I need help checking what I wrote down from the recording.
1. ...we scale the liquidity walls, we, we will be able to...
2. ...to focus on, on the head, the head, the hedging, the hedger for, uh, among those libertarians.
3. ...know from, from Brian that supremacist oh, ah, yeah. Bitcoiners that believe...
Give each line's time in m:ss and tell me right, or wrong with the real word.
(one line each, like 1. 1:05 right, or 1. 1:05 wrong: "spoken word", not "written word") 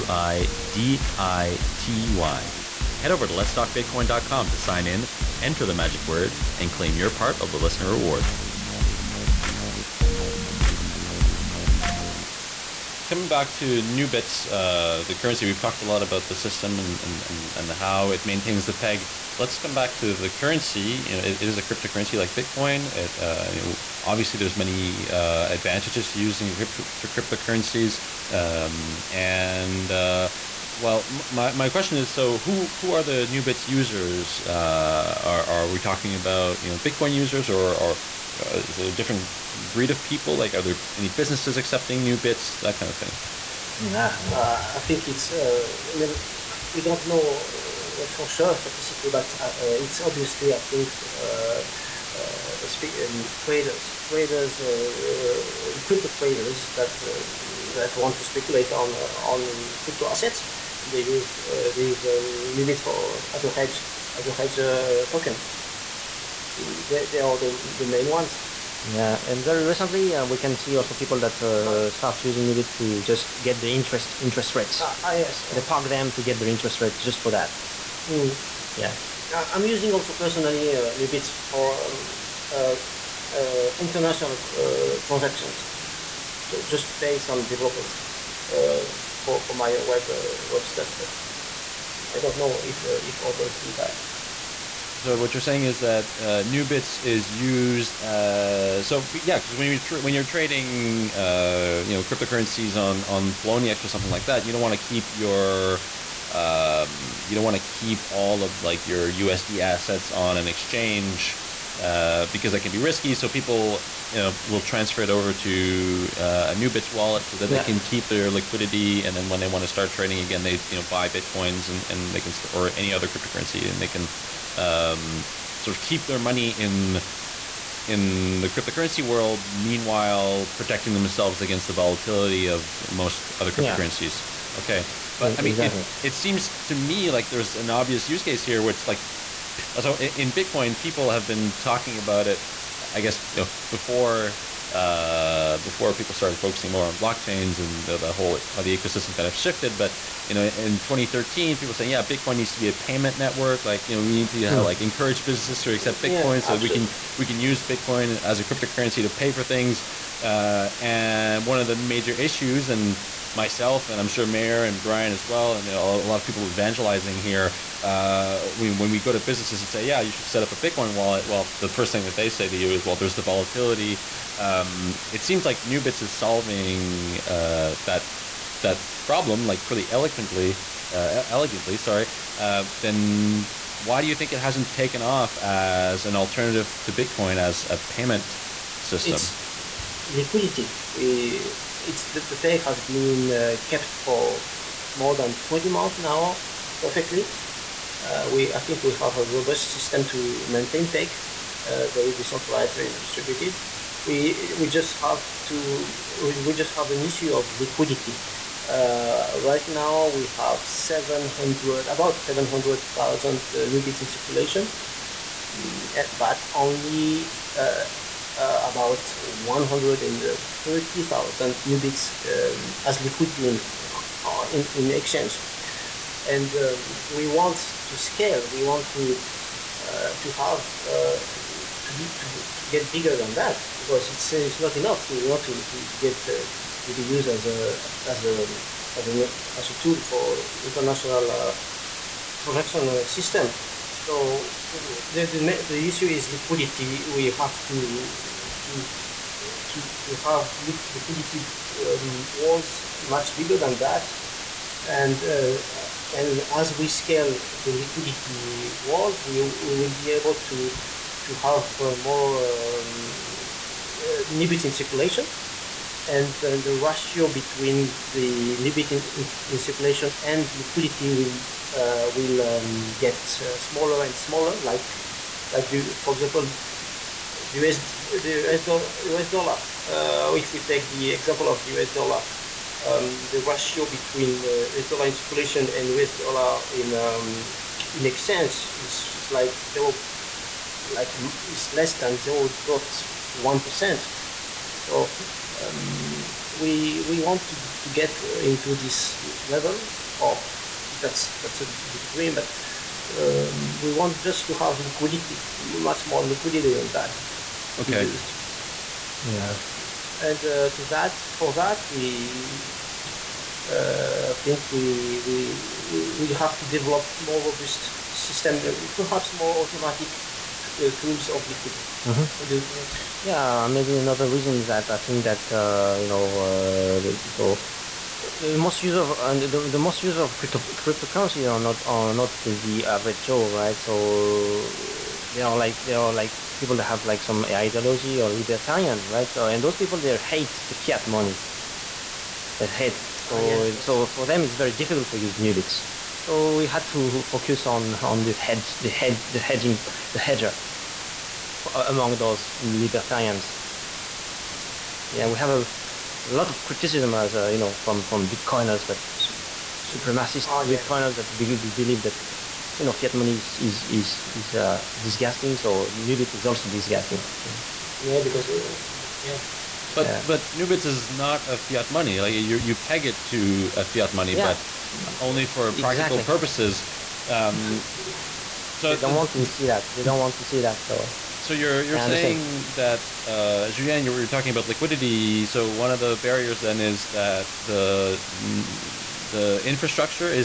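1. 4:16 right
2. 5:46 right
3. 5:57 wrong: "Bitcoiners", not "Brian".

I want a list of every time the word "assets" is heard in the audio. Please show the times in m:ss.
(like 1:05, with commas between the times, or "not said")
1:00, 1:49.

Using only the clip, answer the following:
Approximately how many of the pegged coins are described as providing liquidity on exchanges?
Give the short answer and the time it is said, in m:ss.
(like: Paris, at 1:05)
130,000, at 3:39.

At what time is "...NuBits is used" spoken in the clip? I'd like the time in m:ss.
1:36.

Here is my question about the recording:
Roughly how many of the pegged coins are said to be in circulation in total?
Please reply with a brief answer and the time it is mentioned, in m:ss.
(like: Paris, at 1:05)
700,000, at 3:31.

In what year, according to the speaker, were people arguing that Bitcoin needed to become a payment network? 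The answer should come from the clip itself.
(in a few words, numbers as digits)
2013.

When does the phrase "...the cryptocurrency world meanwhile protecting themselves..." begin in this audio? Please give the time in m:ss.
2:08.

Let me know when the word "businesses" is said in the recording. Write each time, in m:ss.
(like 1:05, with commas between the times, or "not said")
0:41, 2:35, 2:49.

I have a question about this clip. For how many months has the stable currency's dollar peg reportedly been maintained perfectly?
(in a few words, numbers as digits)
20 months.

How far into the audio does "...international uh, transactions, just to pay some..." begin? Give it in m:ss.
1:23.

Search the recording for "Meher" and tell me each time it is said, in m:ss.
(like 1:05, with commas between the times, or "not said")
2:44.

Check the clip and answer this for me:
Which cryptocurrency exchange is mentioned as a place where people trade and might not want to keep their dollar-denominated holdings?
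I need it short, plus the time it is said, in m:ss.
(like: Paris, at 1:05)
Poloniex, at 1:43.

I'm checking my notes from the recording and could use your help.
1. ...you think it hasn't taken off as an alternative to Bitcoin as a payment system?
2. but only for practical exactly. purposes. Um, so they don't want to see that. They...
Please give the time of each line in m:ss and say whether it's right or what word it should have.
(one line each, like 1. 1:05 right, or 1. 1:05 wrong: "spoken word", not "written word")
1. 3:04 right
2. 6:14 right.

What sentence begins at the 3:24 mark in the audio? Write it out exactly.
We, we just have to, we just have an issue of liquidity.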